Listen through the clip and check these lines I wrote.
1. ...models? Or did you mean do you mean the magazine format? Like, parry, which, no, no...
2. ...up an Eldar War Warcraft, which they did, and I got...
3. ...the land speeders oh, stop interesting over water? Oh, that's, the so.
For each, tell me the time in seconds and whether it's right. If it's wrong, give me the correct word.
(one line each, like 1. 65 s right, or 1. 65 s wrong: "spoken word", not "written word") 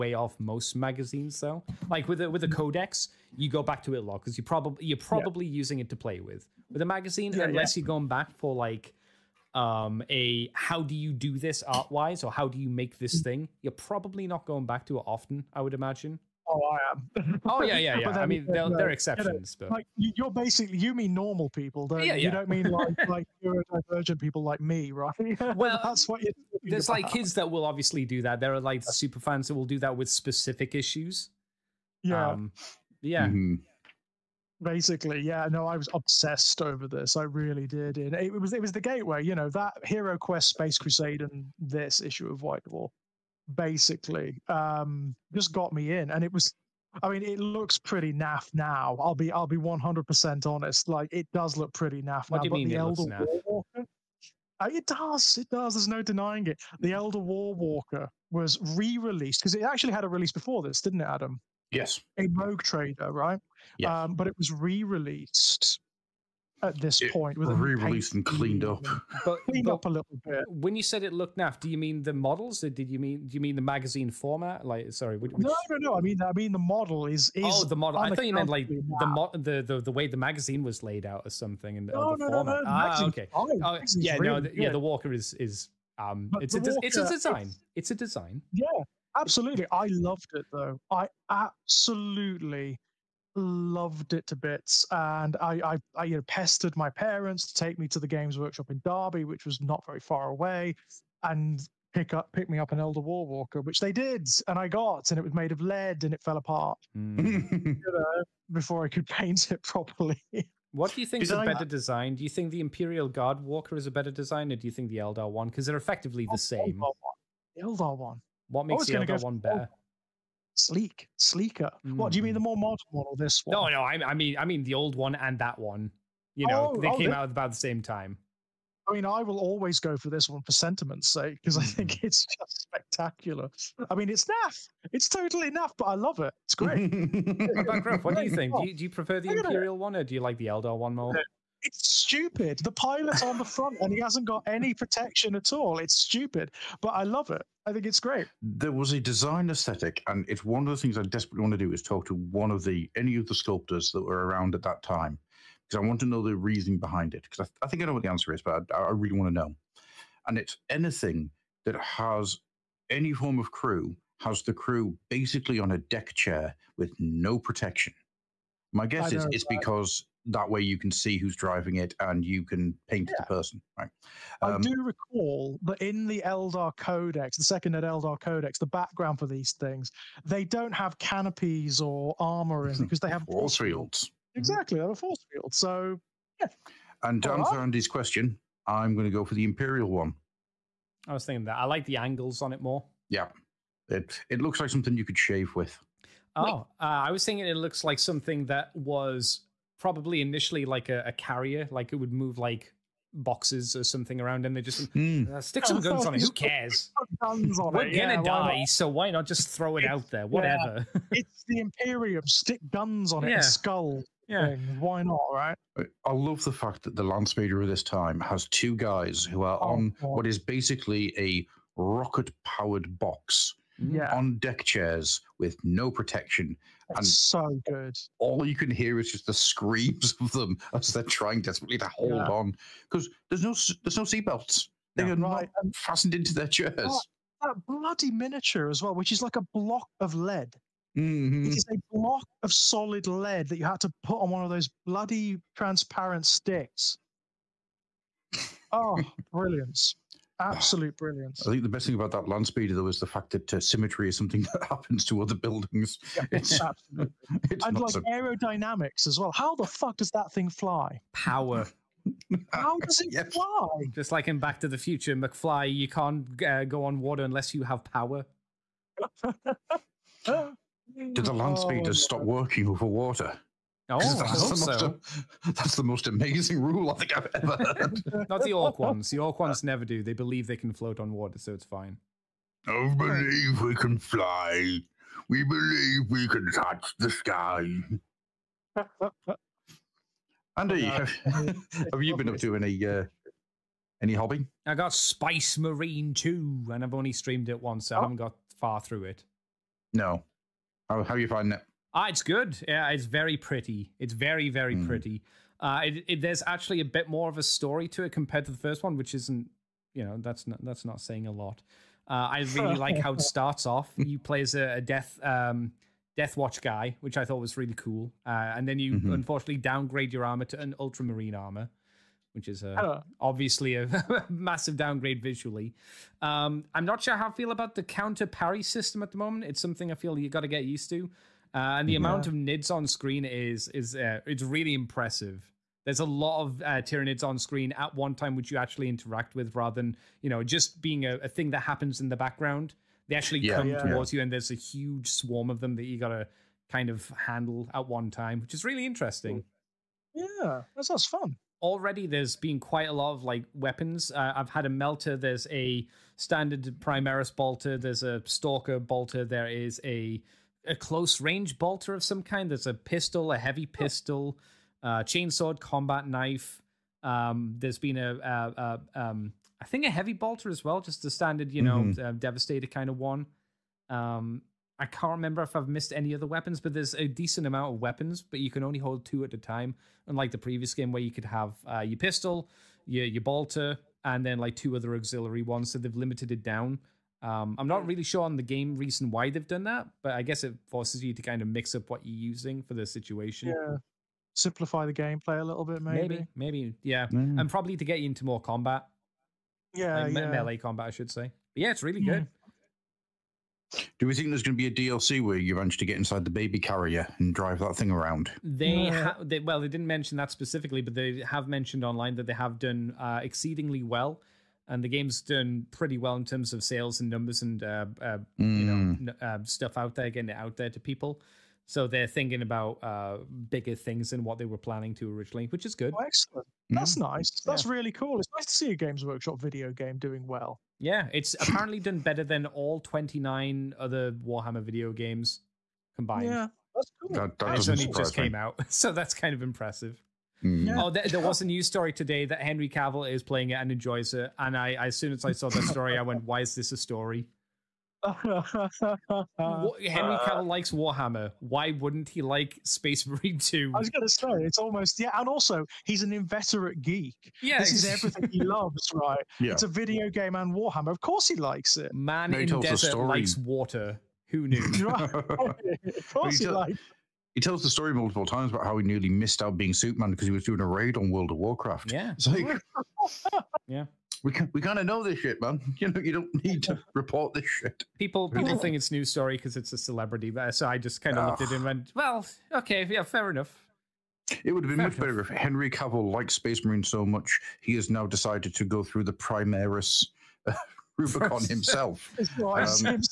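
1. 72 s wrong: "sorry", not "parry"
2. 102 s wrong: "Walker", not "Warcraft"
3. 271 s wrong: "working", not "interesting".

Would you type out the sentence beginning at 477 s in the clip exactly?
People people think it's news story because it's a celebrity, but so I just kind of looked at him and went, ah.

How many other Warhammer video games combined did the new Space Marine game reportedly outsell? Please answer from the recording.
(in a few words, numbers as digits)
29.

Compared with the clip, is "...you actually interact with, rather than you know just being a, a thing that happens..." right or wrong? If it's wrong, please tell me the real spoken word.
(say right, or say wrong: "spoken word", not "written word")
right.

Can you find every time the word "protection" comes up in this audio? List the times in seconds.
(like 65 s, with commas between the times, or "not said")
144 s, 167 s, 225 s.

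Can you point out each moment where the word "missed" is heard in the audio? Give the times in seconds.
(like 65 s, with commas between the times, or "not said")
375 s, 469 s.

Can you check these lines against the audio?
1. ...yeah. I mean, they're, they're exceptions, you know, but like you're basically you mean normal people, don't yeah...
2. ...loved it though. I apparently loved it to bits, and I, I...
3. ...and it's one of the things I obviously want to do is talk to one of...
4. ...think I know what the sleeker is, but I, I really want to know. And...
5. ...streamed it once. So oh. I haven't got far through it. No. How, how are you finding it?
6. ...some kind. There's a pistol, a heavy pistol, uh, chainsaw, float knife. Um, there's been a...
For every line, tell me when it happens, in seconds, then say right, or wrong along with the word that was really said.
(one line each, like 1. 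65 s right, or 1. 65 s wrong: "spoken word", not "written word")
1. 17 s right
2. 89 s wrong: "absolutely", not "apparently"
3. 150 s wrong: "desperately", not "obviously"
4. 157 s wrong: "answer", not "sleeker"
5. 297 s right
6. 362 s wrong: "combat", not "float".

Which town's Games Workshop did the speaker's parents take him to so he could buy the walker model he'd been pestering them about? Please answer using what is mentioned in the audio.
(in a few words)
Derby.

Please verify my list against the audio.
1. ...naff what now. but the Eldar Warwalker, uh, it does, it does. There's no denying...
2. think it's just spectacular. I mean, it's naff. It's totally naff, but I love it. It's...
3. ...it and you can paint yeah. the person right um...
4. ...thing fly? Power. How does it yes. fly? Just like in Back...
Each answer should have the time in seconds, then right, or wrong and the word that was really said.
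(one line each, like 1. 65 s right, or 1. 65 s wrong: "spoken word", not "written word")
1. 52 s right
2. 131 s right
3. 171 s right
4. 260 s right.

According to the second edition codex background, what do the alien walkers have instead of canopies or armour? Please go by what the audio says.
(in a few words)
Force fields.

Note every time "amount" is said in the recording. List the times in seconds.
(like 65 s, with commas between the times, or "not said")
331 s, 377 s.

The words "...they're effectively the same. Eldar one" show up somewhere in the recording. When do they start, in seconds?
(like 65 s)
115 s.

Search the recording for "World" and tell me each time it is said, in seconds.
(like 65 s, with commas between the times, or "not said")
471 s.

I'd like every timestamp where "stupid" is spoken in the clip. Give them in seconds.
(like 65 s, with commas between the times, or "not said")
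141 s, 145 s.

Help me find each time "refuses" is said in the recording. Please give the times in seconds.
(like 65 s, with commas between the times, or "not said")
not said.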